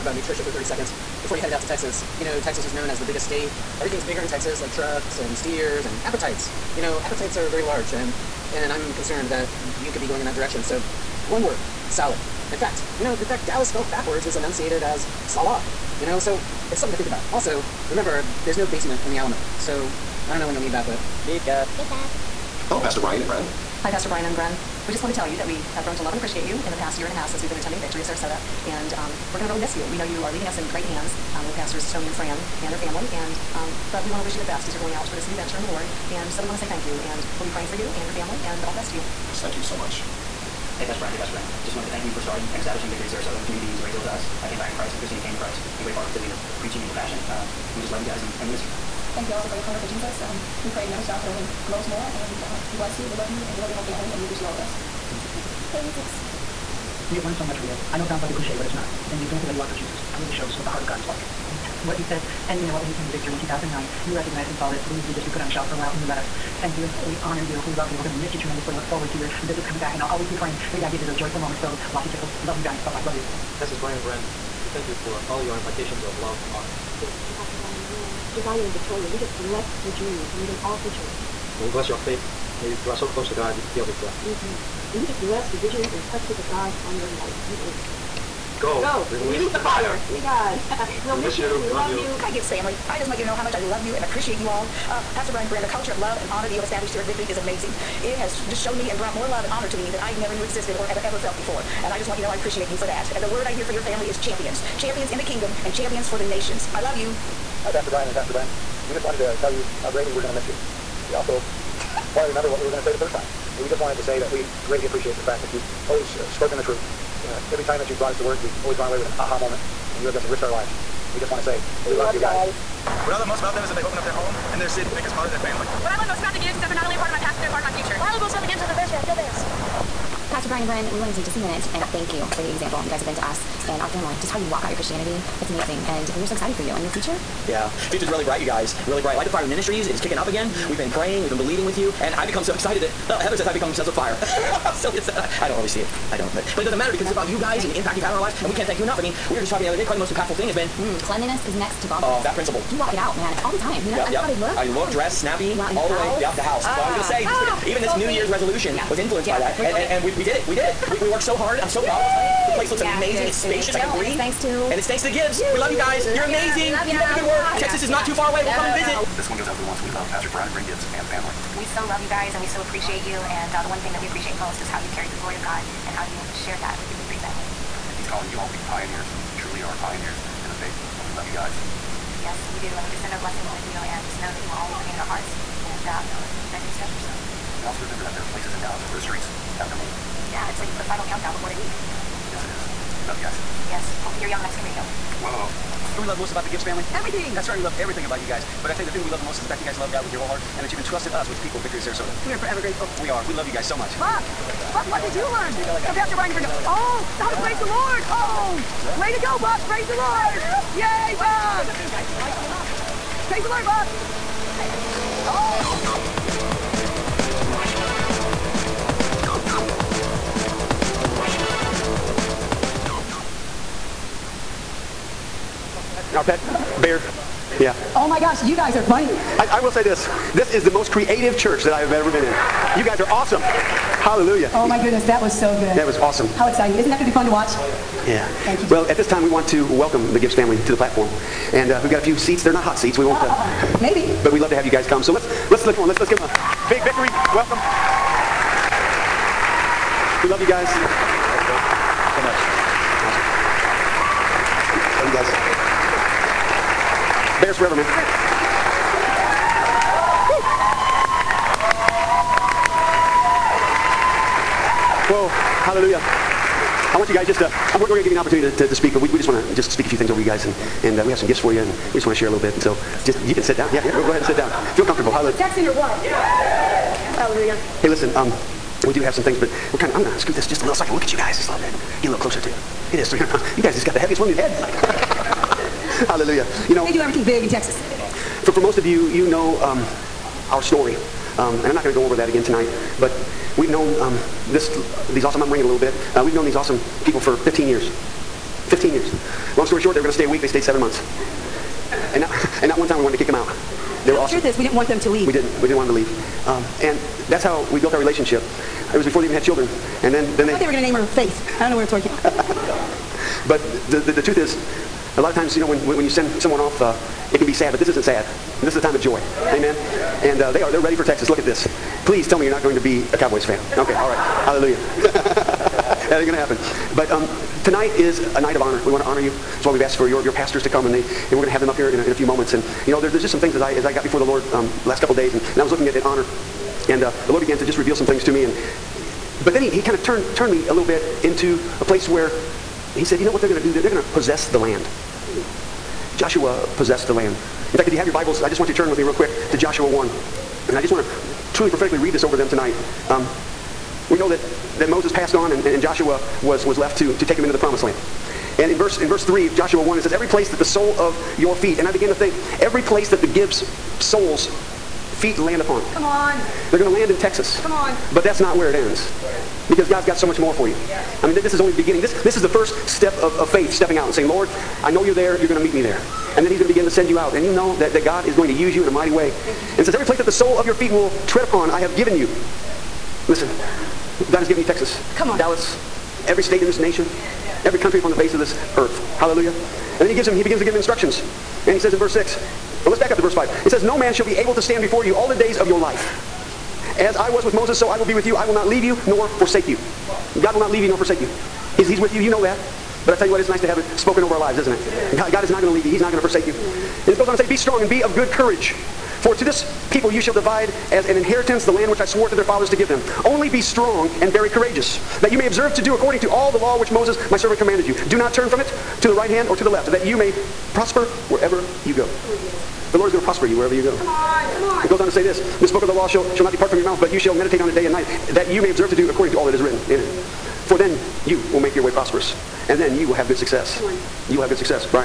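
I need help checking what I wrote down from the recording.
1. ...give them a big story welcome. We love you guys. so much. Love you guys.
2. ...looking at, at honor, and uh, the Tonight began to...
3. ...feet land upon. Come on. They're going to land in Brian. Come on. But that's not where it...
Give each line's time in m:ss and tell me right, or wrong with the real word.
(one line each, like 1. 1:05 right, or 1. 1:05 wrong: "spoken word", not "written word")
1. 4:06 wrong: "victory", not "story"
2. 5:35 wrong: "Lord", not "Tonight"
3. 6:05 wrong: "Texas", not "Brian".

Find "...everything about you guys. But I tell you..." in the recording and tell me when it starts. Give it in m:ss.
3:17.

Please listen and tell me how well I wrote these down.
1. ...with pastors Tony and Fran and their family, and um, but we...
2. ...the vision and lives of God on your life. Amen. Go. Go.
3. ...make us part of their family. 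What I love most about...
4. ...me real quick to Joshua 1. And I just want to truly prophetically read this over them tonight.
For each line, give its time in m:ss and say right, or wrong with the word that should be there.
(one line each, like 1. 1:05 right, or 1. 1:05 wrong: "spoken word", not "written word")
1. 0:31 right
2. 1:25 wrong: "purposes", not "lives"
3. 2:04 right
4. 5:48 right.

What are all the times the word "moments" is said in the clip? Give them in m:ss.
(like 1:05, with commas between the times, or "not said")
1:11, 1:59, 5:32.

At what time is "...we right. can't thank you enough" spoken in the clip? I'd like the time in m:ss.
2:28.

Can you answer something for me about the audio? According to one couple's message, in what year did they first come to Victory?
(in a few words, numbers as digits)
2009.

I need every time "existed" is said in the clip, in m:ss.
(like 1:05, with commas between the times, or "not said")
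1:40.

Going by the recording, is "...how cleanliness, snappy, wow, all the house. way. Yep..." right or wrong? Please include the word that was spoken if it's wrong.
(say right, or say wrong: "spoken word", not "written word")
wrong: "dress", not "cleanliness".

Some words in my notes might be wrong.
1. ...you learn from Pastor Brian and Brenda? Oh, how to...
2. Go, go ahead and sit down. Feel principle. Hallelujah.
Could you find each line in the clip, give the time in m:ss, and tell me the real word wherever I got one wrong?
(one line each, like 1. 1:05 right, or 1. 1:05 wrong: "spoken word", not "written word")
1. 3:25 right
2. 4:33 wrong: "comfortable", not "principle".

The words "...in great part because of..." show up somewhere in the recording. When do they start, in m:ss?
0:45.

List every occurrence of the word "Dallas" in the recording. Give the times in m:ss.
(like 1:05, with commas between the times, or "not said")
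0:13, 3:08, 6:25.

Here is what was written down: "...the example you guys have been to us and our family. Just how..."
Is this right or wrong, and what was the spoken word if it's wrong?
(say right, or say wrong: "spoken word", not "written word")
right.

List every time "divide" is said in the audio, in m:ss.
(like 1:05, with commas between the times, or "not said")
6:50.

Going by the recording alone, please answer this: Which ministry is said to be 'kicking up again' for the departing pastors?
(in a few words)
Light the Fire Ministries.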